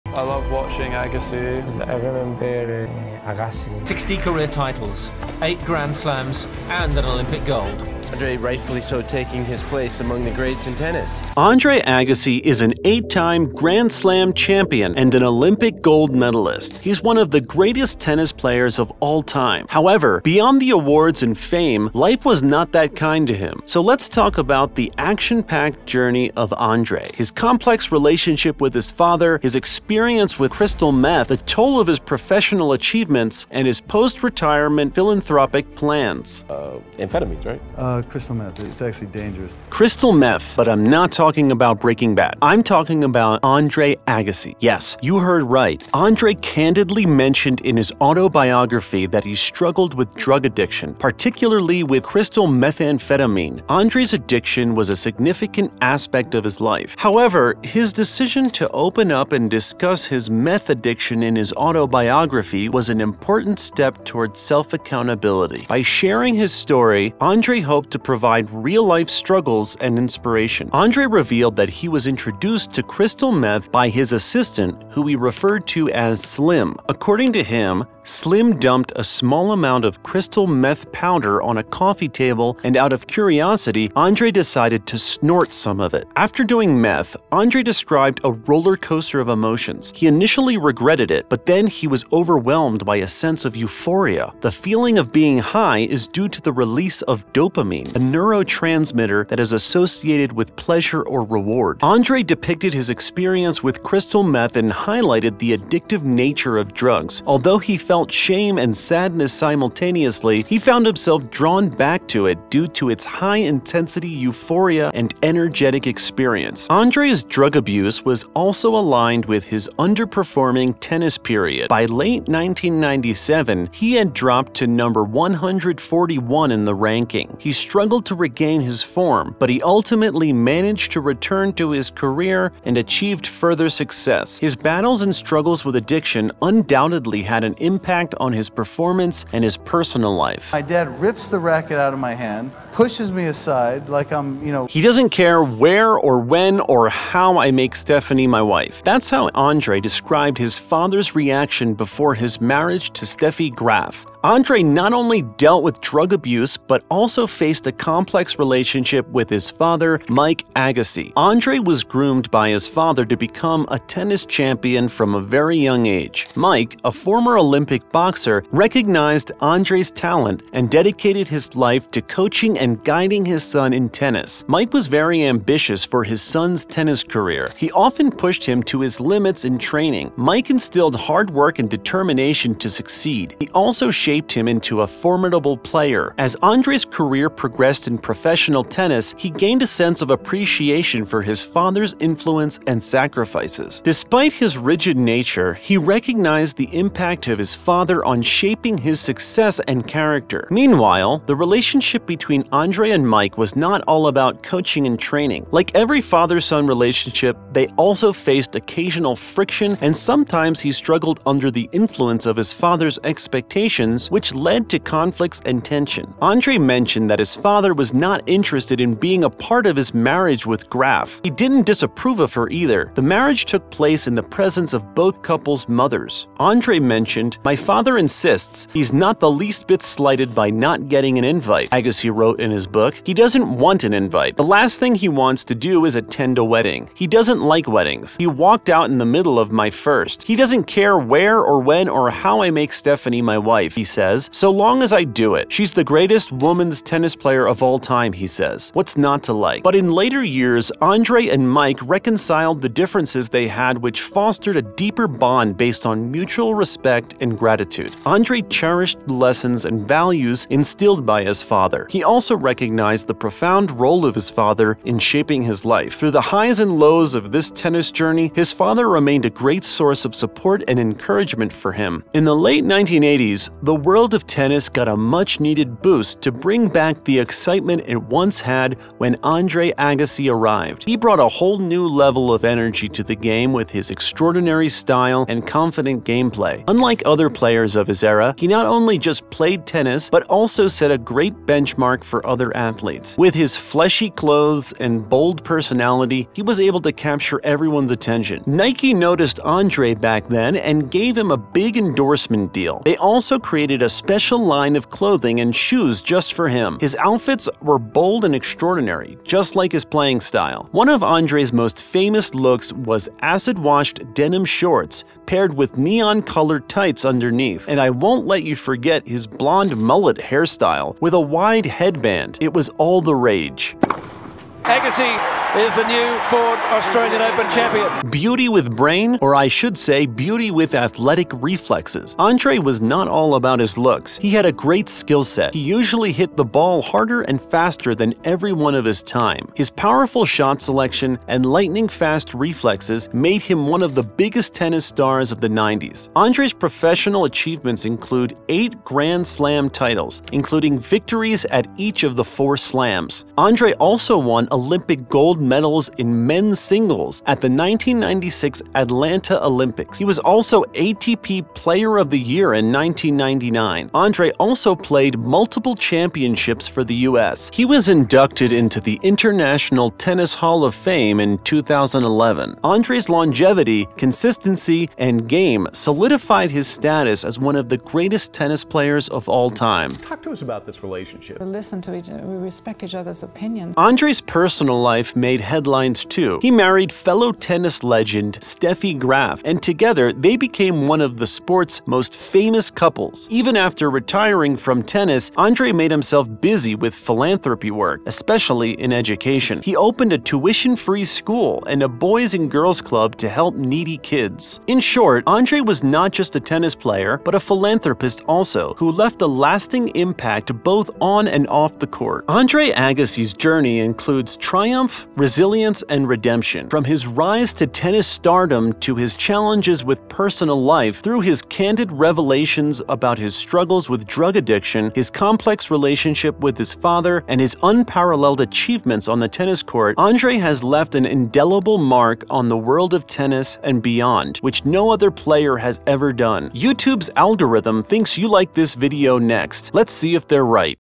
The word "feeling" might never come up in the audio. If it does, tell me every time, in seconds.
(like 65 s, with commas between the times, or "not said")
94 s.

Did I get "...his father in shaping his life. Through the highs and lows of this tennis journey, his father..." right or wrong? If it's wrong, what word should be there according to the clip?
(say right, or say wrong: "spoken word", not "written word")
right.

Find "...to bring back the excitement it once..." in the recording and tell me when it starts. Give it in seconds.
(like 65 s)
276 s.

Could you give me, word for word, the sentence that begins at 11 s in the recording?
Andre Agassi is an eight-time Grand Slam champion and an Olympic gold medalist.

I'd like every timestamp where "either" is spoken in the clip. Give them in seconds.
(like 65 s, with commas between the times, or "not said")
222 s.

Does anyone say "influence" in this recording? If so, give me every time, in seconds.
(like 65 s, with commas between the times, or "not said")
191 s, 211 s.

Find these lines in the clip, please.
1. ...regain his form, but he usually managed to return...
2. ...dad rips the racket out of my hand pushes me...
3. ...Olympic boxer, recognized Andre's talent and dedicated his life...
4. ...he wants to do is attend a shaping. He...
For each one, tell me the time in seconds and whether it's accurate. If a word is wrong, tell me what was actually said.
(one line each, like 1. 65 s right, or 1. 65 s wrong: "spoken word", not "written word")
1. 128 s wrong: "ultimately", not "usually"
2. 140 s right
3. 167 s right
4. 234 s wrong: "wedding", not "shaping".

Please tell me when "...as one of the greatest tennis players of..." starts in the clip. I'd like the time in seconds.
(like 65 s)
377 s.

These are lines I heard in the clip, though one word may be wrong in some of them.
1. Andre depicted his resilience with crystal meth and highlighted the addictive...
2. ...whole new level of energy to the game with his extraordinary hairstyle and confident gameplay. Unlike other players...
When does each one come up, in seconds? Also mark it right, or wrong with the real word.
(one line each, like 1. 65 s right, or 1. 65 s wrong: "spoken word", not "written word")
1. 101 s wrong: "experience", not "resilience"
2. 281 s wrong: "style", not "hairstyle".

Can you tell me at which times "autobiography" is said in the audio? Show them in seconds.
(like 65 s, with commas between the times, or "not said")
48 s, 61 s.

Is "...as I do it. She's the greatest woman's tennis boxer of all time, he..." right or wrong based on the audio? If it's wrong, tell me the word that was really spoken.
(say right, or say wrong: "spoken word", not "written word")
wrong: "player", not "boxer".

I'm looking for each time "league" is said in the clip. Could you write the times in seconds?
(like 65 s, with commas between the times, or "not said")
not said.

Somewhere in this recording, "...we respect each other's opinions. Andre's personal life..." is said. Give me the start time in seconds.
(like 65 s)
382 s.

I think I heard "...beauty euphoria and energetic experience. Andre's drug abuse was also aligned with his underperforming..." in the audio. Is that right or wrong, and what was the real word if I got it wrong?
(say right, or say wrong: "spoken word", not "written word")
wrong: "intensity", not "beauty".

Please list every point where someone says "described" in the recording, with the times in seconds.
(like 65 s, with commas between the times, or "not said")
87 s, 149 s.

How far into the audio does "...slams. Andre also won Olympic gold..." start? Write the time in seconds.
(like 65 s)
352 s.